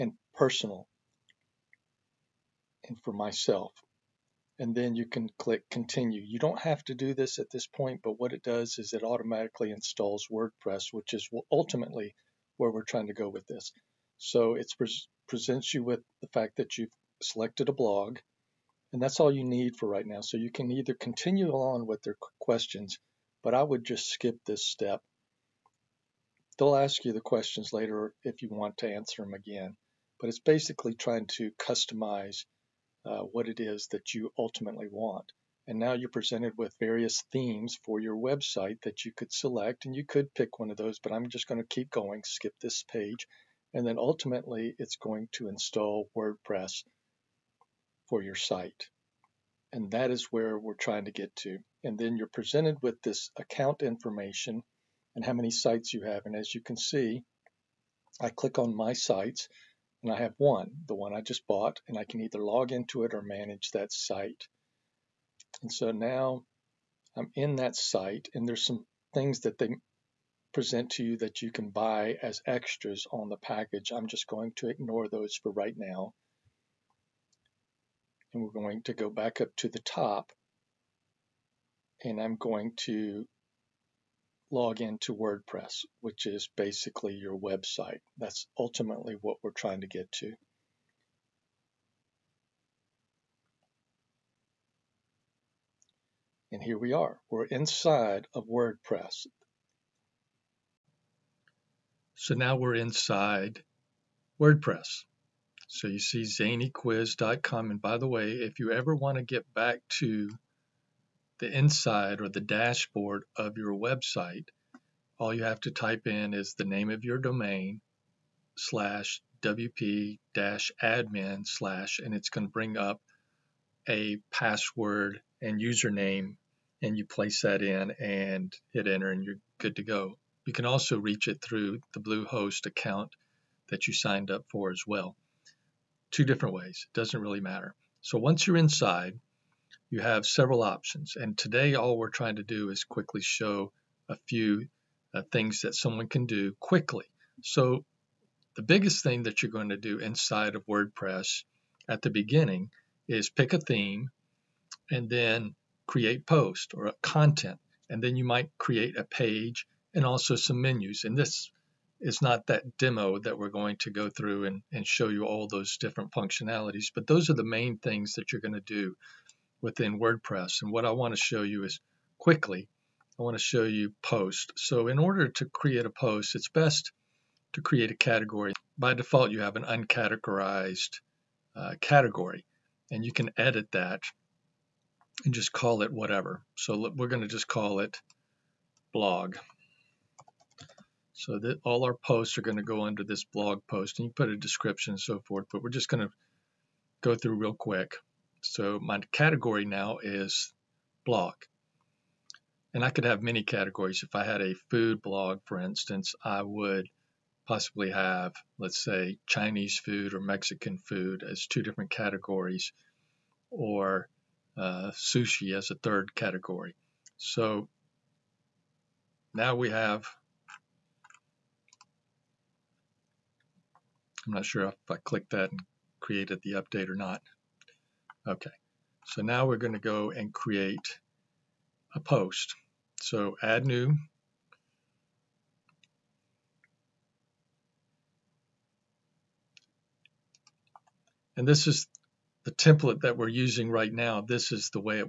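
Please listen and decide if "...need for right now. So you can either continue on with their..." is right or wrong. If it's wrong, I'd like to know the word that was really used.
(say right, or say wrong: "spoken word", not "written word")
right.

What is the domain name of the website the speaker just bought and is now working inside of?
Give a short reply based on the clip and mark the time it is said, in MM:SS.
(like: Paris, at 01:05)
zanyquiz.com, at 01:46.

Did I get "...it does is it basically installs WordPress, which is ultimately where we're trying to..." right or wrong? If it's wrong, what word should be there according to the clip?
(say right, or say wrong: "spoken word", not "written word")
wrong: "automatically", not "basically".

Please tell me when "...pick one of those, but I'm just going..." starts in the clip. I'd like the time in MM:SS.
00:40.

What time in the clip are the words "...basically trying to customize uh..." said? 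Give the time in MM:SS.
00:30.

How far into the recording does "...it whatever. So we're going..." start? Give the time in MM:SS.
03:05.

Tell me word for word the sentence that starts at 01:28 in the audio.
That's ultimately what we're trying to get to.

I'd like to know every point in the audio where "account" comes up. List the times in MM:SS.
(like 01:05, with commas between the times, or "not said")
00:53, 02:12.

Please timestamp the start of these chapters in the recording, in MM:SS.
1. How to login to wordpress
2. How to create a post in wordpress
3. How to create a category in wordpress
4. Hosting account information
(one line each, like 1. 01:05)
1. 01:20
2. 02:30
3. 02:55
4. 00:50.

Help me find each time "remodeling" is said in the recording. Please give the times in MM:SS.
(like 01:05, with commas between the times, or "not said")
not said.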